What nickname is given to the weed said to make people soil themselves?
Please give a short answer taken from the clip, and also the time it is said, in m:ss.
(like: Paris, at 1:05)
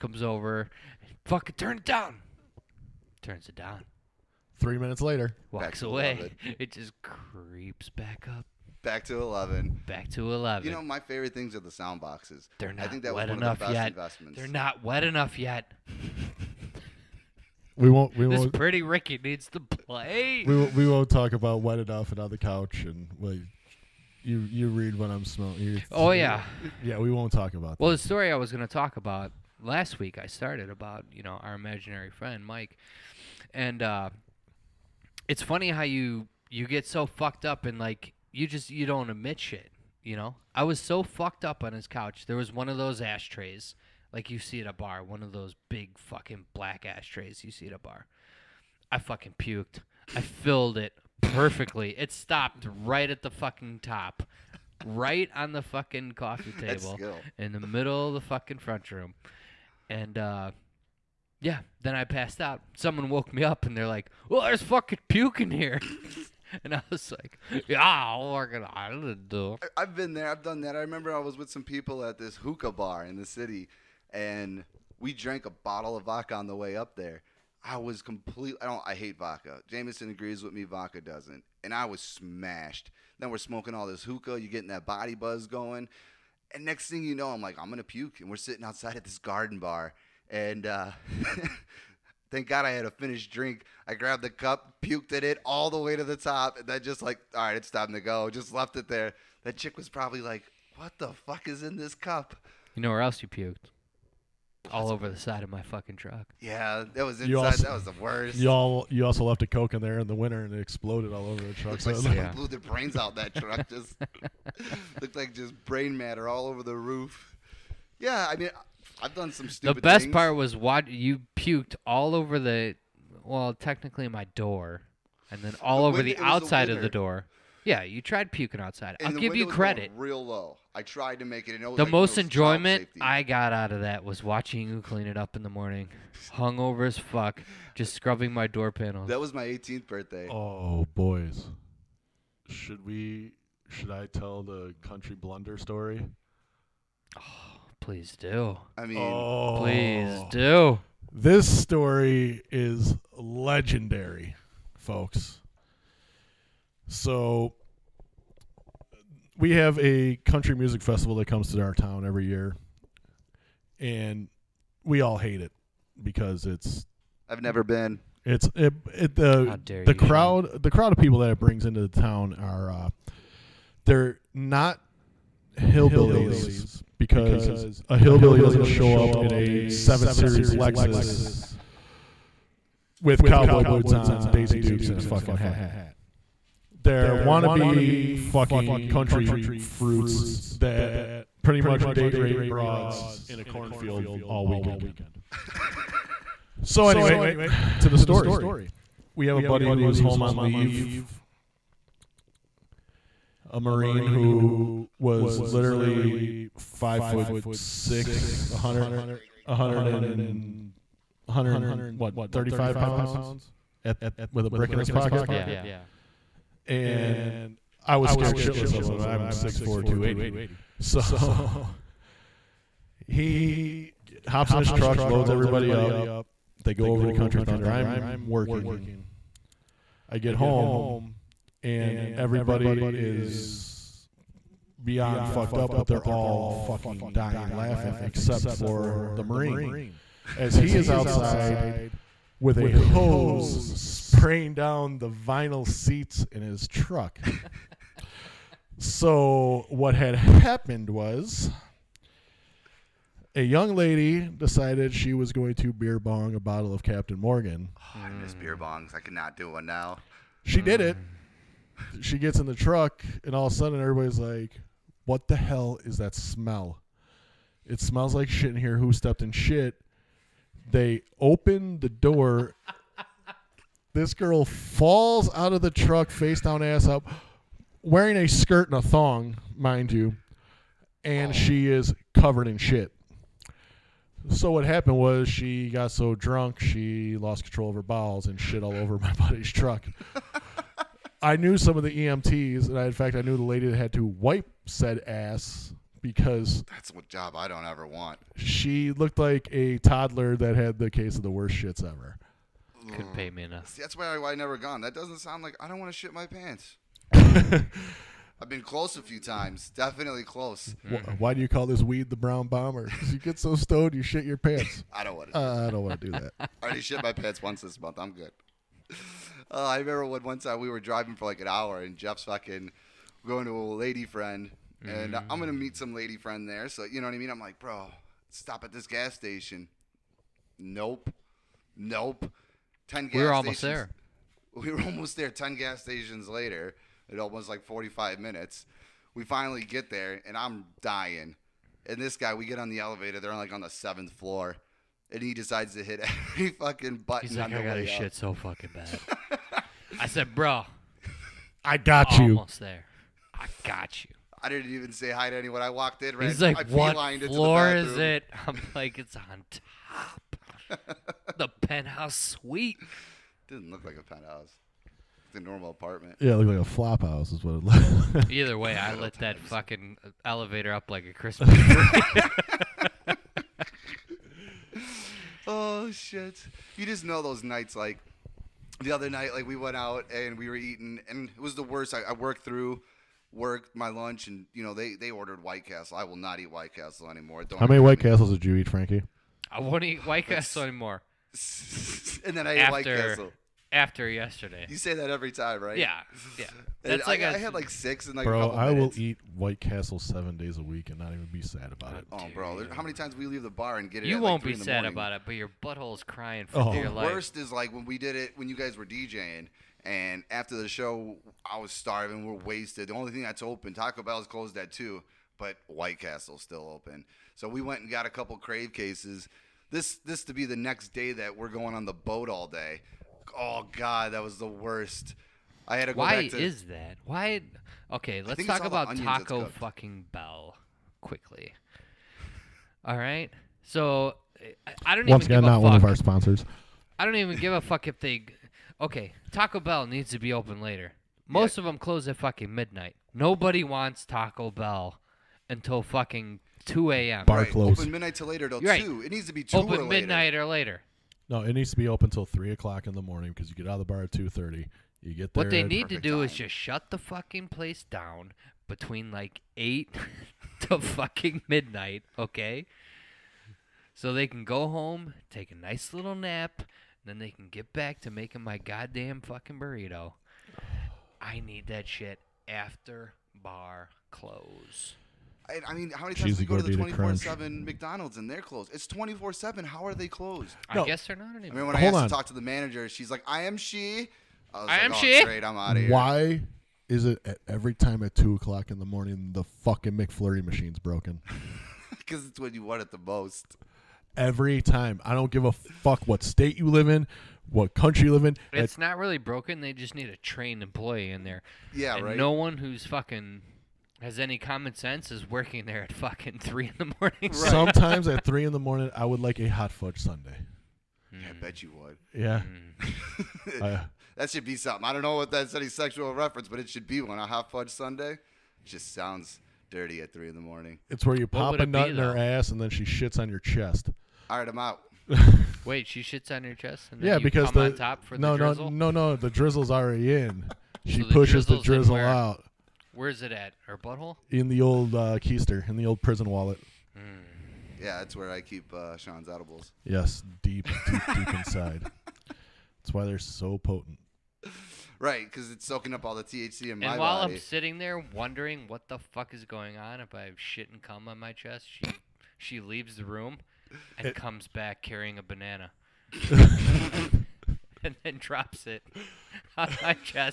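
the brown bomber, at 5:12.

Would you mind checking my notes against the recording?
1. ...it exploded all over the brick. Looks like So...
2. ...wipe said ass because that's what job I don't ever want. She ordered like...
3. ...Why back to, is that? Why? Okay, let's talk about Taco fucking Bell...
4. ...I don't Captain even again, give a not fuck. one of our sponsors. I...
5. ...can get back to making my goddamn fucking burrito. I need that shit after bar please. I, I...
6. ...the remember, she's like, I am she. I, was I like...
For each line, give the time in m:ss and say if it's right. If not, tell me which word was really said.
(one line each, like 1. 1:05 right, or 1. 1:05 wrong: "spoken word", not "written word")
1. 1:50 wrong: "truck", not "brick"
2. 4:54 wrong: "looked", not "ordered"
3. 7:05 right
4. 7:14 wrong: "Once", not "Captain"
5. 7:47 wrong: "close", not "please"
6. 8:02 wrong: "manager", not "remember".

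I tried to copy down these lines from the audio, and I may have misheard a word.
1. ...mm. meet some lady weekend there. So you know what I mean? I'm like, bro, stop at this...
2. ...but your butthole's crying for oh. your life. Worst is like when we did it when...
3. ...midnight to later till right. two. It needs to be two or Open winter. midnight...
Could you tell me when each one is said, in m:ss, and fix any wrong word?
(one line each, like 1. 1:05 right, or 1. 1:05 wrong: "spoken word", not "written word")
1. 5:25 wrong: "friend", not "weekend"
2. 6:45 right
3. 7:27 wrong: "later", not "winter".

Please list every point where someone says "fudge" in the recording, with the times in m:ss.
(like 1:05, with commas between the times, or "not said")
8:29, 8:37.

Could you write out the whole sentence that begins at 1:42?
You know where else you puked?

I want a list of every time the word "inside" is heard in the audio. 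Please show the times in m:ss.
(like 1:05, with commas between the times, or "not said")
1:47, 9:01.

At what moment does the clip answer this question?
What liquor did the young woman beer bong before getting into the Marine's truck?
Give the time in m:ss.
4:16.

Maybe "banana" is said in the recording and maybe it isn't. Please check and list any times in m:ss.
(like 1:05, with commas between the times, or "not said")
9:15.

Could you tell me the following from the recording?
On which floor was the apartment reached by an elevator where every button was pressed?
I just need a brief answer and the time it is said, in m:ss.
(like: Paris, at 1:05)
seventh floor, at 5:43.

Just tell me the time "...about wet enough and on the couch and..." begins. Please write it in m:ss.
0:21.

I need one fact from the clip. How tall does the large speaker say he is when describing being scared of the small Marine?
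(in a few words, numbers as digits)
6'4".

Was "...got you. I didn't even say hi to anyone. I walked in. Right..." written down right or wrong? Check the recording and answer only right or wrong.
right.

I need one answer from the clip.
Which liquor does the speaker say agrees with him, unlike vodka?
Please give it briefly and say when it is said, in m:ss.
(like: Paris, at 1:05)
Jameson, at 1:19.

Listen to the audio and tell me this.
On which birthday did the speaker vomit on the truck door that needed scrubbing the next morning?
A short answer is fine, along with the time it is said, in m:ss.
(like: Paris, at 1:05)
18th, at 2:19.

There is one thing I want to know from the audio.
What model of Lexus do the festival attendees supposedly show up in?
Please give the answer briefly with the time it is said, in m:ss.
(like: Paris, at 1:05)
seven series, at 2:59.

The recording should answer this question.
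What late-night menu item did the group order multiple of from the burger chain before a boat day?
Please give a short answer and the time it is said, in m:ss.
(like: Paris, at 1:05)
crave cases, at 6:58.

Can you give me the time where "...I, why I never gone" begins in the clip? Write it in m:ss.
5:04.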